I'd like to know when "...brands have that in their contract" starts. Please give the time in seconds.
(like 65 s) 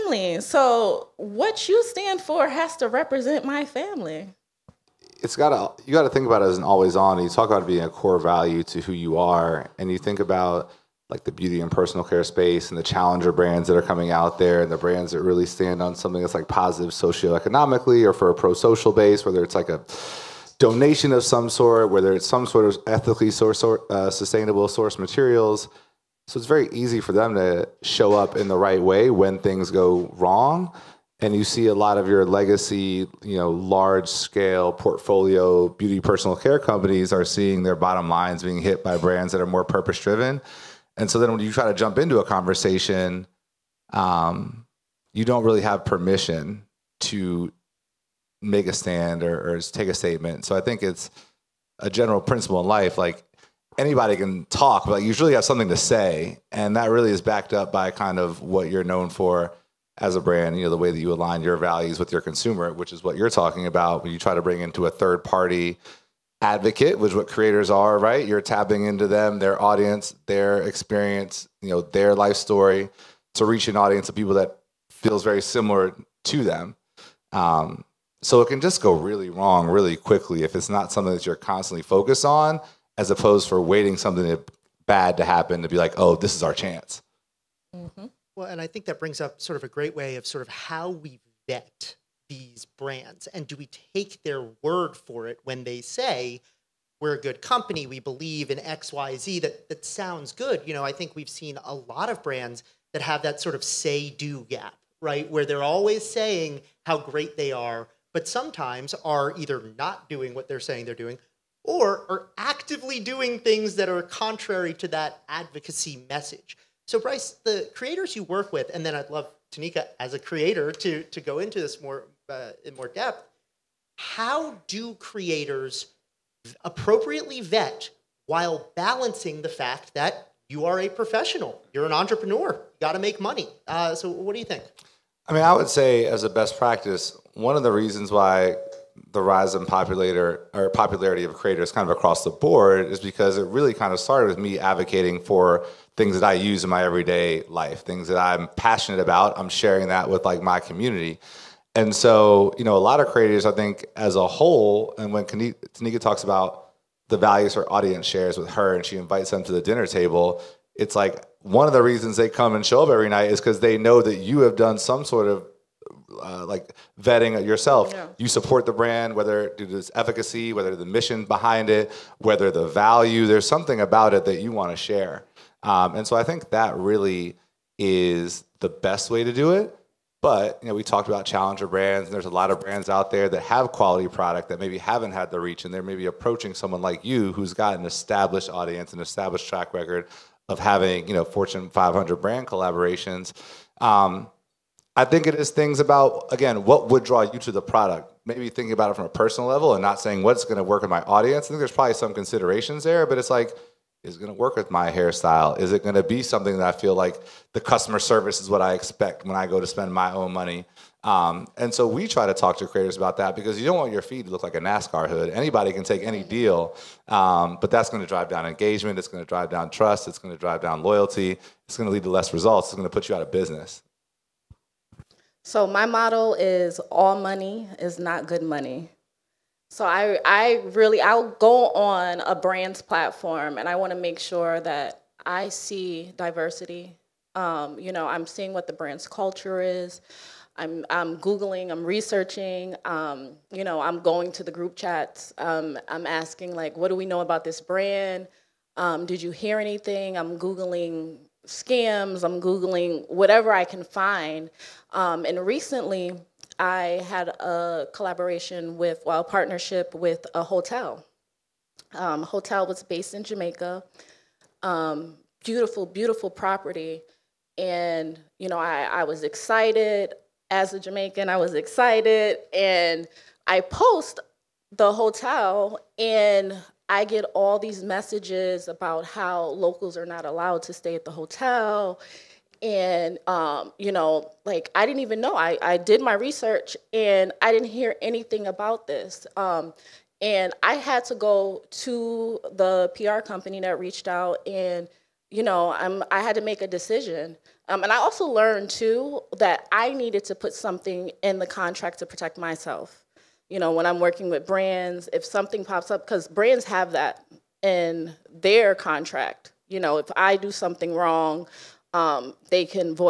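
306 s.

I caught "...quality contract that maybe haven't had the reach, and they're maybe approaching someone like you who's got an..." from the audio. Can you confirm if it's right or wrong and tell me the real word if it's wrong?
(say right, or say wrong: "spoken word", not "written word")
wrong: "product", not "contract".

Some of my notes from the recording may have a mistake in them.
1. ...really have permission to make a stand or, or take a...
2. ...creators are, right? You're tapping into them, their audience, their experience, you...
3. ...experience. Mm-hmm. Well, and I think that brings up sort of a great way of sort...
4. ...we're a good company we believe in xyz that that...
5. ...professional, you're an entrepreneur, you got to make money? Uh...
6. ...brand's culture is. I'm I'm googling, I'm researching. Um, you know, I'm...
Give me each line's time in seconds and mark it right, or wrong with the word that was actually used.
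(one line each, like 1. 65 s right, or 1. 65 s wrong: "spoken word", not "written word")
1. 45 s right
2. 67 s right
3. 86 s wrong: "chance", not "experience"
4. 97 s right
5. 130 s right
6. 238 s right.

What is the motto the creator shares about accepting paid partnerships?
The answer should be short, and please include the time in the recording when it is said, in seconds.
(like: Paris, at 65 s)
All money is not good money, at 226 s.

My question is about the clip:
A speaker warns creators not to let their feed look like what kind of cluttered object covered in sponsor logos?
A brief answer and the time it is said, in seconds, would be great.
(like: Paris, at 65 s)
NASCAR hood, at 214 s.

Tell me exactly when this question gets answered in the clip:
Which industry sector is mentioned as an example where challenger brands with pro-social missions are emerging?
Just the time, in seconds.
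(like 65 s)
11 s.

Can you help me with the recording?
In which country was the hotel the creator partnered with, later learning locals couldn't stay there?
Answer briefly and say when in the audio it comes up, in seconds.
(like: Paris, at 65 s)
Jamaica, at 263 s.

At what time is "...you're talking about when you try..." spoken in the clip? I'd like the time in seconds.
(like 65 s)
63 s.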